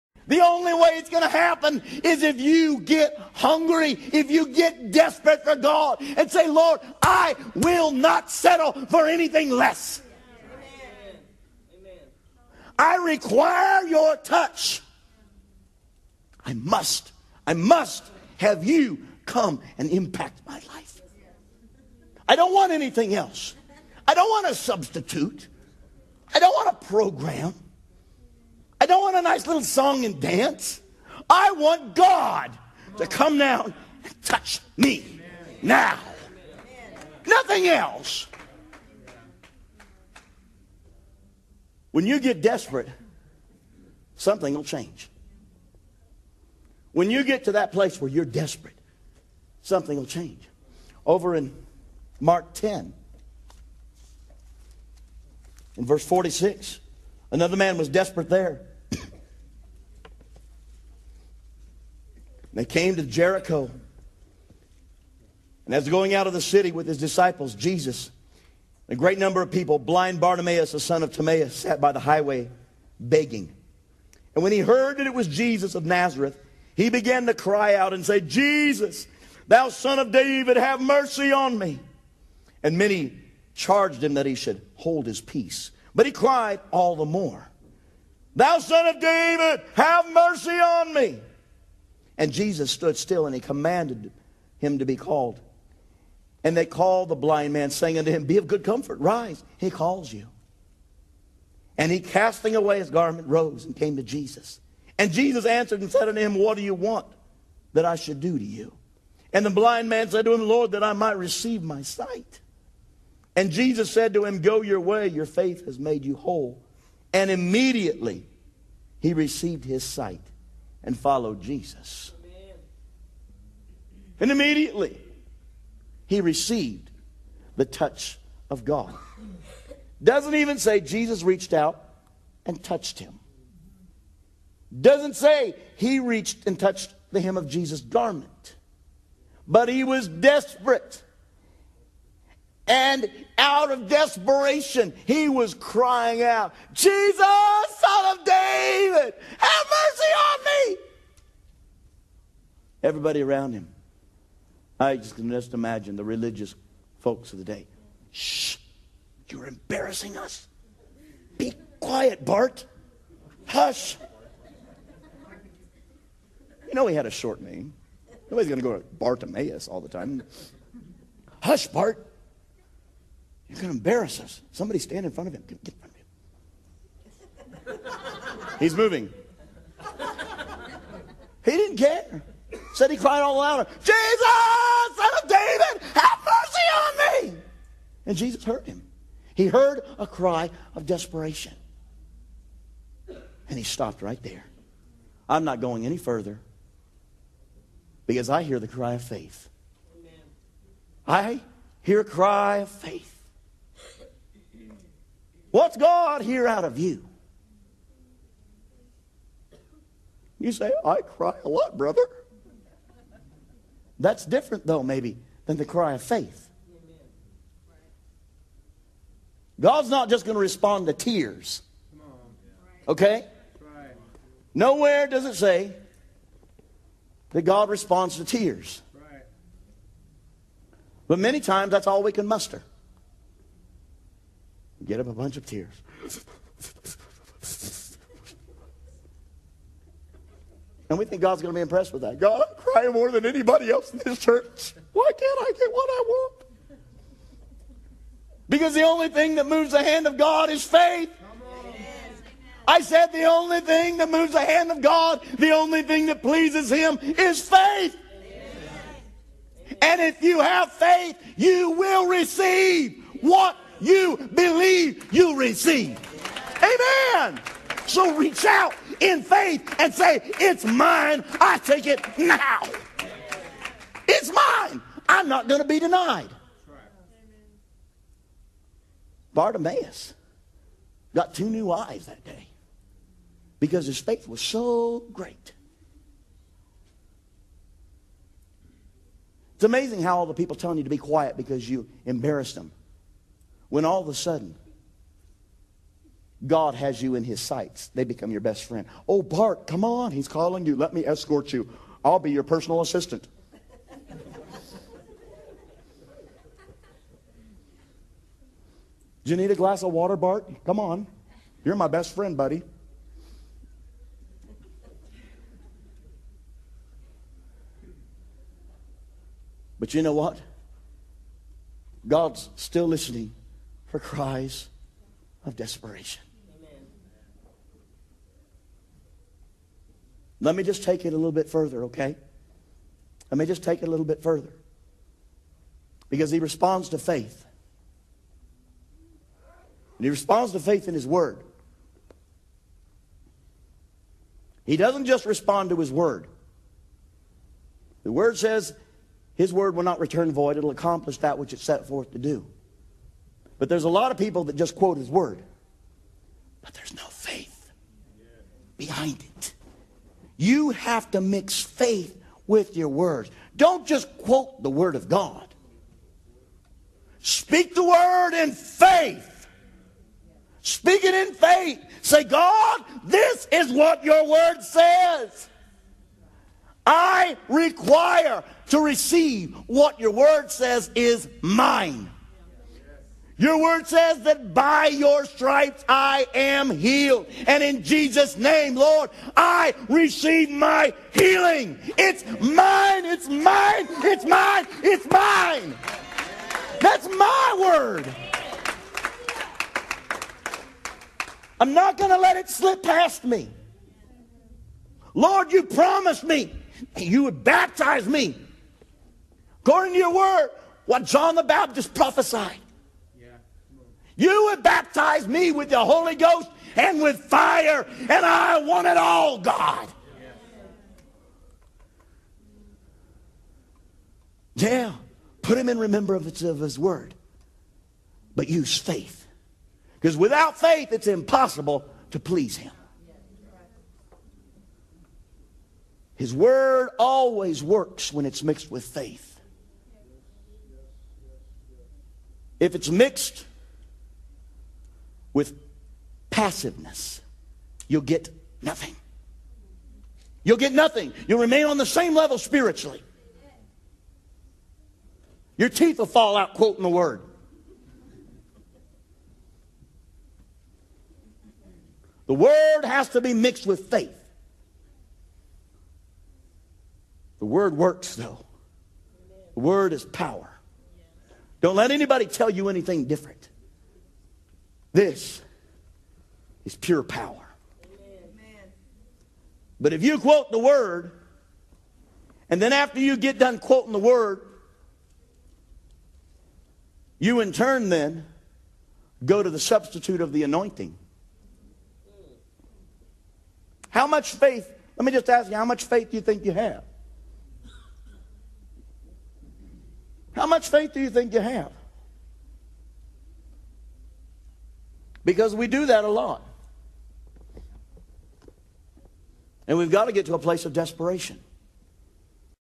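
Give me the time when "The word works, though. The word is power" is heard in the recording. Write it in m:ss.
7:47.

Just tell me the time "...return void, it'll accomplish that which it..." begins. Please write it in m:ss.
5:49.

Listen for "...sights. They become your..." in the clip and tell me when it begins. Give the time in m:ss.
4:57.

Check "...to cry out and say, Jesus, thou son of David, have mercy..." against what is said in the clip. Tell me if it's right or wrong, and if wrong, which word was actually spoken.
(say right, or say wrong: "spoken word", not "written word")
right.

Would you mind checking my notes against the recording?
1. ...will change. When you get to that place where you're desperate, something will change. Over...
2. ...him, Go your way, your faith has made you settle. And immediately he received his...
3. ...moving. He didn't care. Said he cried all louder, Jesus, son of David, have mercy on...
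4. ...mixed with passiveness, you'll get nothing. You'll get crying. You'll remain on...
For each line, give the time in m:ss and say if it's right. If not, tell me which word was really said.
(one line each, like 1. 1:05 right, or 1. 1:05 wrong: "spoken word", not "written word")
1. 0:44 right
2. 1:54 wrong: "whole", not "settle"
3. 2:58 right
4. 7:22 wrong: "nothing", not "crying".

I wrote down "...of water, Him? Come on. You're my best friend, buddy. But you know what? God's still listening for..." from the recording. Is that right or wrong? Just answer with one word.
wrong.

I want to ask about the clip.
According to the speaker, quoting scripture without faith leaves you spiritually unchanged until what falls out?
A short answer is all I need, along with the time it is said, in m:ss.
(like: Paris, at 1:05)
Teeth, at 7:35.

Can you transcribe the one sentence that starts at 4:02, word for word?
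God, I'm crying more than anybody else in this church.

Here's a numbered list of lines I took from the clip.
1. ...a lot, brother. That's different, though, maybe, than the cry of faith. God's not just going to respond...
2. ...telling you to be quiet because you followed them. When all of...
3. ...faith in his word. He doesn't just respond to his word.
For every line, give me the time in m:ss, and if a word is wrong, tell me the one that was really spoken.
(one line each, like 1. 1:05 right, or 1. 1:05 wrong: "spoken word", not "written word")
1. 3:31 right
2. 4:50 wrong: "embarrassed", not "followed"
3. 5:40 right.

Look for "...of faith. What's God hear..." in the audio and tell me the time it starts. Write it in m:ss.
3:22.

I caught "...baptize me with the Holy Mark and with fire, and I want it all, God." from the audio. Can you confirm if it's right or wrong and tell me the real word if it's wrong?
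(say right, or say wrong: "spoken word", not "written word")
wrong: "Ghost", not "Mark".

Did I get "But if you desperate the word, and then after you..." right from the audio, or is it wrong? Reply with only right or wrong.
wrong.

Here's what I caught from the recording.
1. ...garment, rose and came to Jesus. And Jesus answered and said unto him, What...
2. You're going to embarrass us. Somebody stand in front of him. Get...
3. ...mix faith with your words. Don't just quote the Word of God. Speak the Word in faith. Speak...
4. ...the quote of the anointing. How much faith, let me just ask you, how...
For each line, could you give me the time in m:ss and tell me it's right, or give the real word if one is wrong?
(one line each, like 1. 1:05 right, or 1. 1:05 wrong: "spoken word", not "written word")
1. 1:42 right
2. 2:53 right
3. 6:01 right
4. 8:09 wrong: "substitute", not "quote".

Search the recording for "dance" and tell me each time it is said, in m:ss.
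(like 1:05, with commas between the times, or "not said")
0:30.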